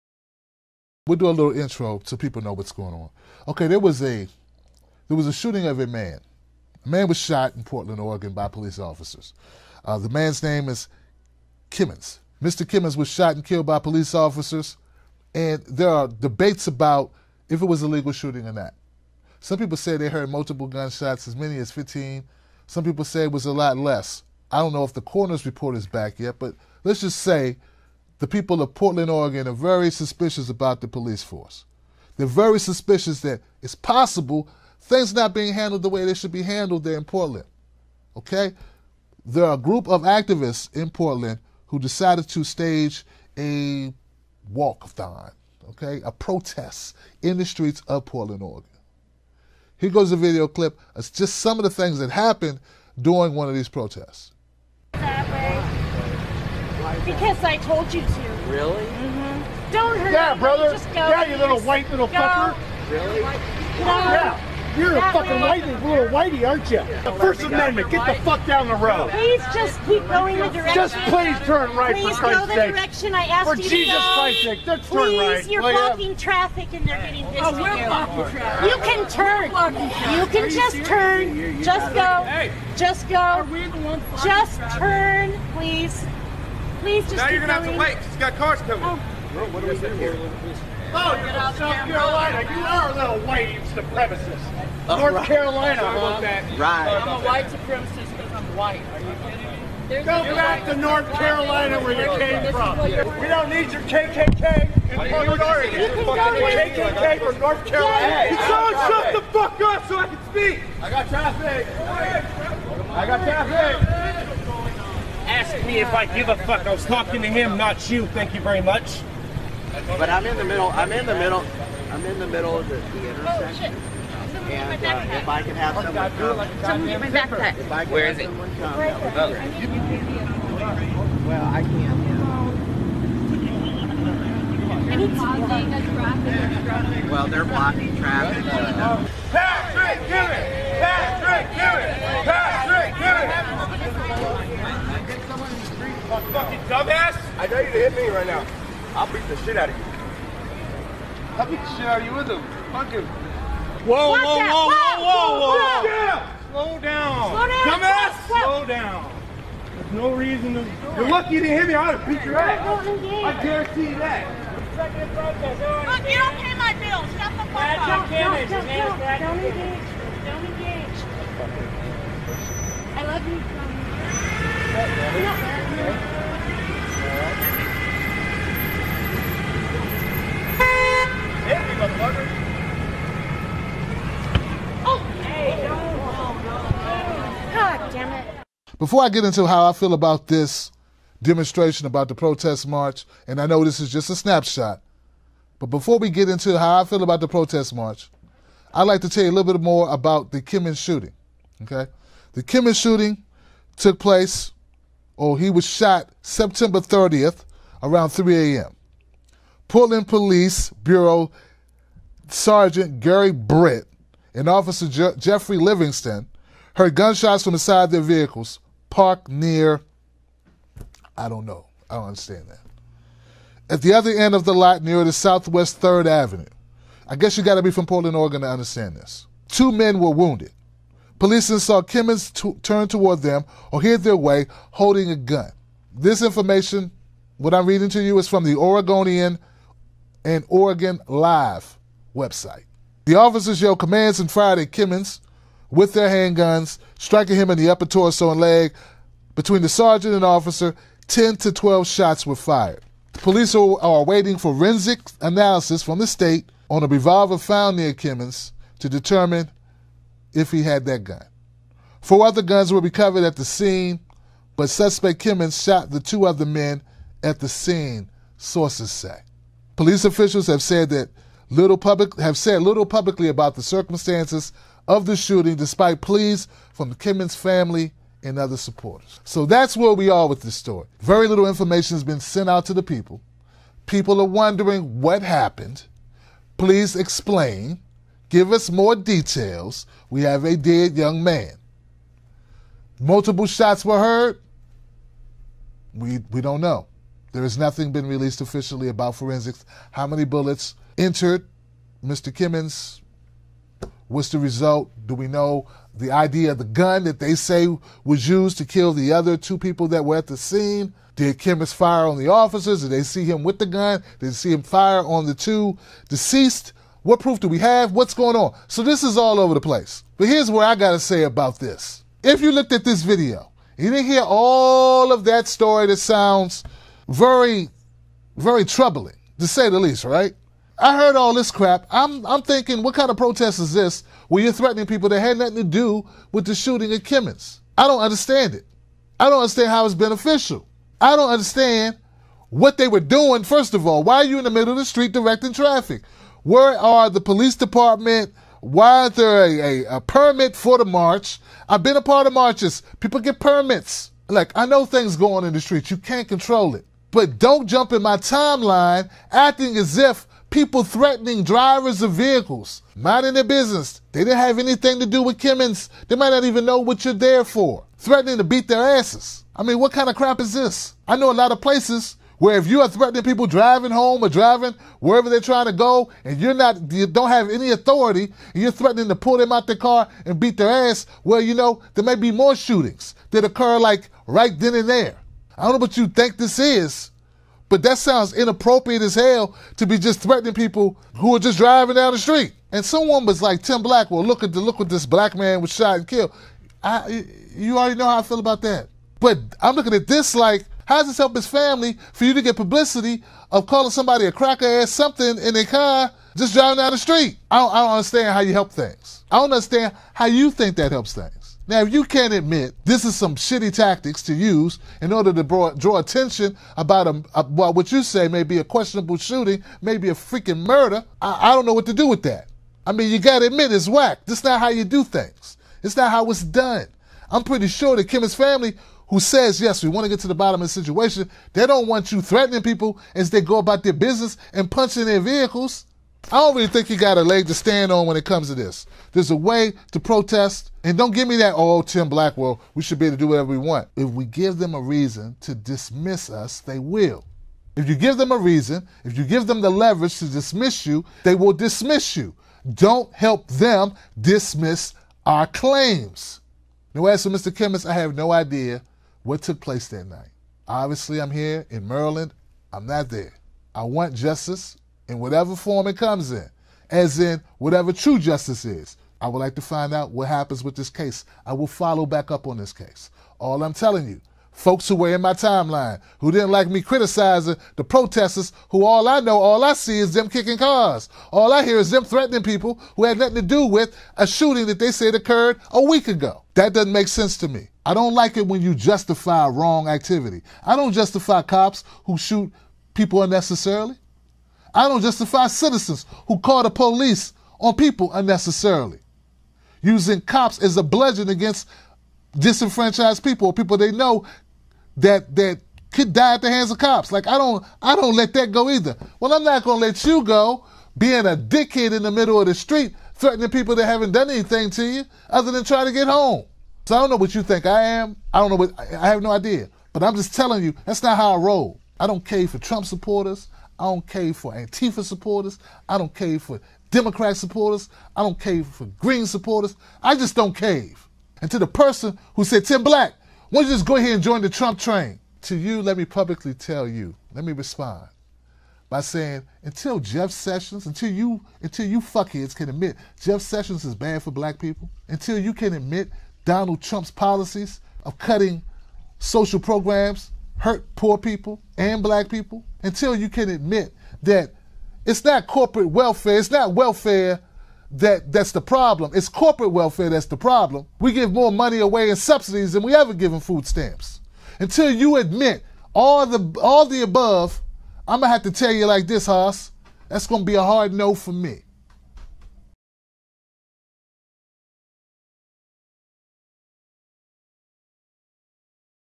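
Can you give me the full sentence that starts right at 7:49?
I would like to find out what happens with this case.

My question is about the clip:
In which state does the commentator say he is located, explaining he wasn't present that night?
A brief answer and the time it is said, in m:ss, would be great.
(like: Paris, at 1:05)
Maryland, at 7:41.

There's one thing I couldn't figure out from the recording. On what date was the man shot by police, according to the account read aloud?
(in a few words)
September 30th.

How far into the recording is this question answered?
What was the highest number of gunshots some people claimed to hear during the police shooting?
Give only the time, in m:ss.
0:21.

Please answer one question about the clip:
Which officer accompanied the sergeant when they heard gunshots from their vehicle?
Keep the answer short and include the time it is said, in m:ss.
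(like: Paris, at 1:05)
Jeffrey Livingston, at 3:35.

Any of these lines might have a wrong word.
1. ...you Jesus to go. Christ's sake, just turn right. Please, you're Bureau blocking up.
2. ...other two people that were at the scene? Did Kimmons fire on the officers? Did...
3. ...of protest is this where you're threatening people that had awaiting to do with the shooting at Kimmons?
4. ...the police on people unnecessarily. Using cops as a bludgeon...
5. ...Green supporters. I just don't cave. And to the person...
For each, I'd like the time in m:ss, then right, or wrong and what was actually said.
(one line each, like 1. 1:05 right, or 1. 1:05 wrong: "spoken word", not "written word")
1. 1:13 wrong: "Play", not "Bureau"
2. 5:09 right
3. 5:33 wrong: "nothing", not "awaiting"
4. 8:16 right
5. 8:48 right.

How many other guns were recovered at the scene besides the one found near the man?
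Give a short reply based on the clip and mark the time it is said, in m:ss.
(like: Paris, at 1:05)
4, at 4:22.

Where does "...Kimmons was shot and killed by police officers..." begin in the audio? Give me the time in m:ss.
0:12.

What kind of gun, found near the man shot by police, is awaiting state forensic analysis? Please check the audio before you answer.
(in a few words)
Revolver.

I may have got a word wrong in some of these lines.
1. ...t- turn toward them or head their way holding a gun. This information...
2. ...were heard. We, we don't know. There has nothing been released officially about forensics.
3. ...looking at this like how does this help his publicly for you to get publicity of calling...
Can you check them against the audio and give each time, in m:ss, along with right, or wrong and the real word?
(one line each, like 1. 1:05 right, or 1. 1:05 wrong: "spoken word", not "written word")
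1. 3:52 right
2. 4:53 right
3. 6:39 wrong: "family", not "publicly".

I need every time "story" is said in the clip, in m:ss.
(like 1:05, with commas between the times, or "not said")
4:40, 5:25.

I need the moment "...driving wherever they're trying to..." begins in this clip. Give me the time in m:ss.
6:14.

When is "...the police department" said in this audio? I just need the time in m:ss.
5:47.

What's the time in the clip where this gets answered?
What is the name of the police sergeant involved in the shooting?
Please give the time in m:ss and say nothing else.
3:32.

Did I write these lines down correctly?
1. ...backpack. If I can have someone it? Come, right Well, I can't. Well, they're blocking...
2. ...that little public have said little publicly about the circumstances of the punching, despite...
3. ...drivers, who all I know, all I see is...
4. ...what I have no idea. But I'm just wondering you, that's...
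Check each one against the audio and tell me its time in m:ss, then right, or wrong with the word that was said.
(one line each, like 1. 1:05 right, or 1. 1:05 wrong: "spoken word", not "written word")
1. 2:07 right
2. 4:30 wrong: "shooting", not "punching"
3. 7:57 wrong: "protesters", not "drivers"
4. 8:38 wrong: "telling", not "wondering".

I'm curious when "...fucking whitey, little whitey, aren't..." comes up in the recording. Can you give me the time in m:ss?
1:05.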